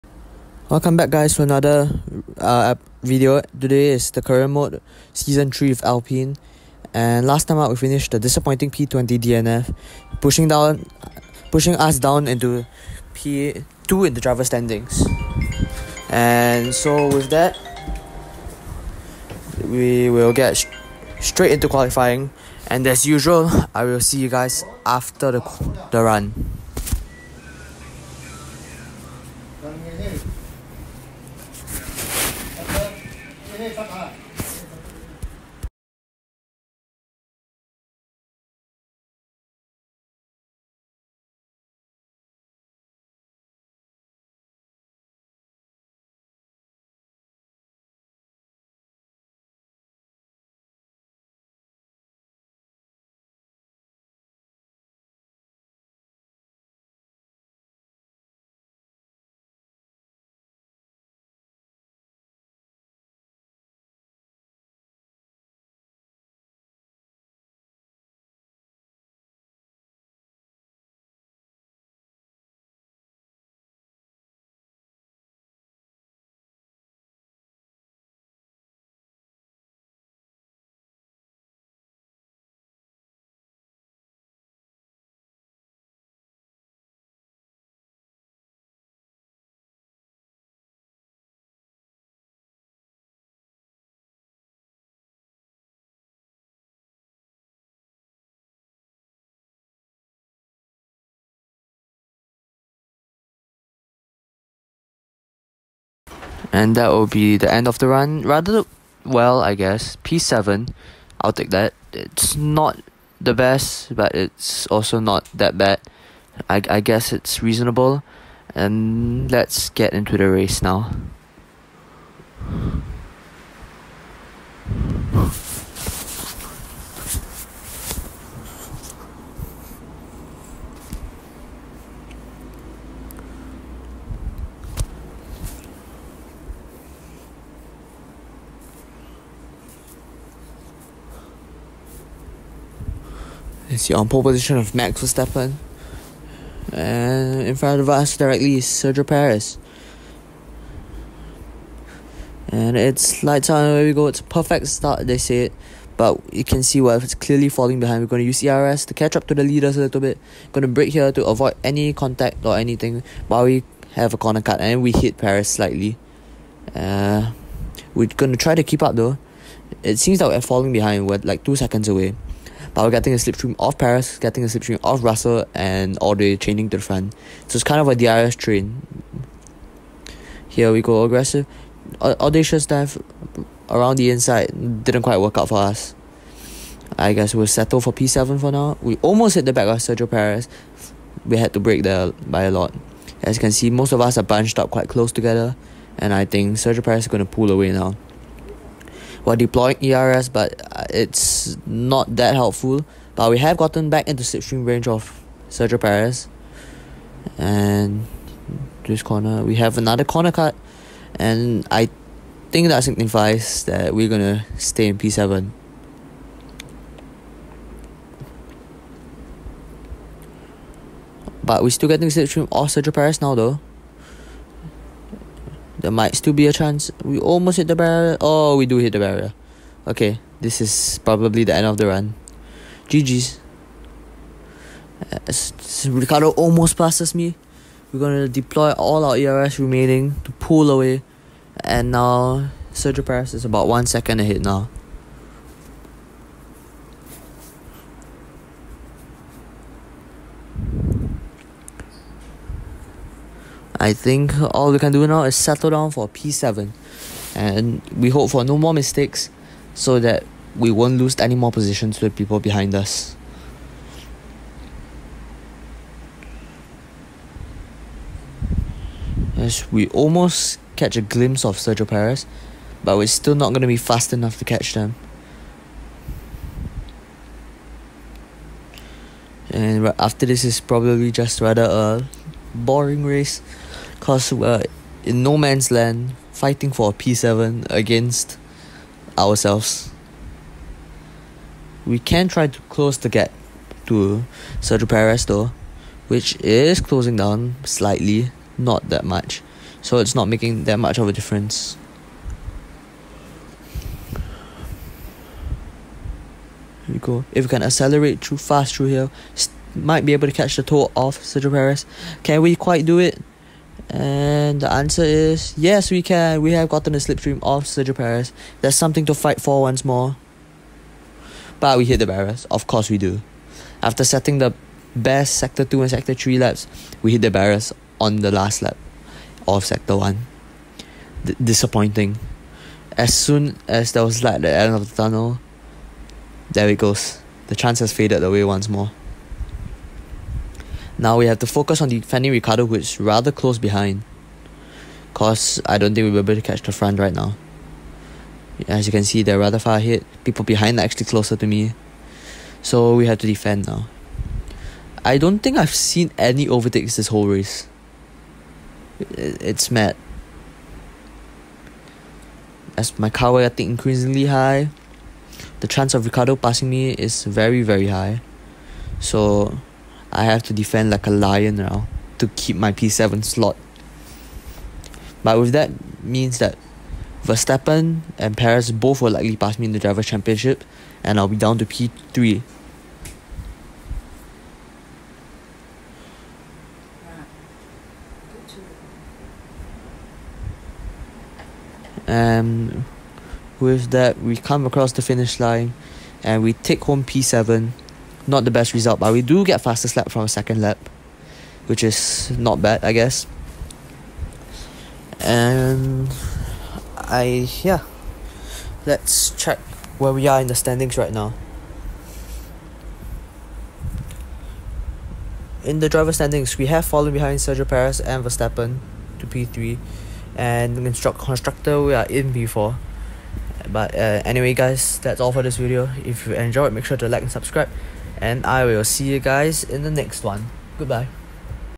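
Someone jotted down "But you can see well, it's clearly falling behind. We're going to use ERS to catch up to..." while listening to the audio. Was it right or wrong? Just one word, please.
right.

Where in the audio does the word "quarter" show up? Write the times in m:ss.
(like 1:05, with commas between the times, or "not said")
not said.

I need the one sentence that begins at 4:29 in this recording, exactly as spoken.
Yes, we almost catch a glimpse of Sergio Perez, but we're still not going to be fast enough to catch them.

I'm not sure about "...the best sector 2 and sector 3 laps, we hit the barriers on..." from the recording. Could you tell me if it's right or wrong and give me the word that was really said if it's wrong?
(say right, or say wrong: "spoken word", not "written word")
right.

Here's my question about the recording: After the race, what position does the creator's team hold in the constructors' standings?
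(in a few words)
P4.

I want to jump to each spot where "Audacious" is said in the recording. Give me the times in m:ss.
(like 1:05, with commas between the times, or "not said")
3:02.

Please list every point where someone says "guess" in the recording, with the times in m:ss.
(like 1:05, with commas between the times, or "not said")
1:49, 1:56, 3:07, 6:42.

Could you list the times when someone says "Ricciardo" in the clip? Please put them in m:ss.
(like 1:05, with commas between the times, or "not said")
3:55, 5:42, 6:06.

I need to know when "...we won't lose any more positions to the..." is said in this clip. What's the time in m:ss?
4:20.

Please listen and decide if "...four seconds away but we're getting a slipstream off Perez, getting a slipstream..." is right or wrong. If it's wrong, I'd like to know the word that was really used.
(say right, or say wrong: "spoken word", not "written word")
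wrong: "two", not "four".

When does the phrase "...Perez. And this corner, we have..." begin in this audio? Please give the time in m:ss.
3:25.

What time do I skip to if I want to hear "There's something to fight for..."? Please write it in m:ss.
5:18.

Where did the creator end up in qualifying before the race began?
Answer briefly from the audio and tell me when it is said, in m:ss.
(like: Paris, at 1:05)
P7, at 1:50.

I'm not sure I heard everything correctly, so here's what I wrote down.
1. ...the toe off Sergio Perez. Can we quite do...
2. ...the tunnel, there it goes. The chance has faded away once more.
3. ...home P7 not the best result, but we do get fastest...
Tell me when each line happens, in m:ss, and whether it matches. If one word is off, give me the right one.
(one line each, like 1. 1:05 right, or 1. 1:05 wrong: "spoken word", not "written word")
1. 5:10 right
2. 5:34 right
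3. 6:36 right.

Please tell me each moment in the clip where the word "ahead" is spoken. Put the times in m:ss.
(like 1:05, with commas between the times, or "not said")
4:04, 5:49.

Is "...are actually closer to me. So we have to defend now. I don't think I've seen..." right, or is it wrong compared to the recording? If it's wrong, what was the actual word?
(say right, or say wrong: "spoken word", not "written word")
right.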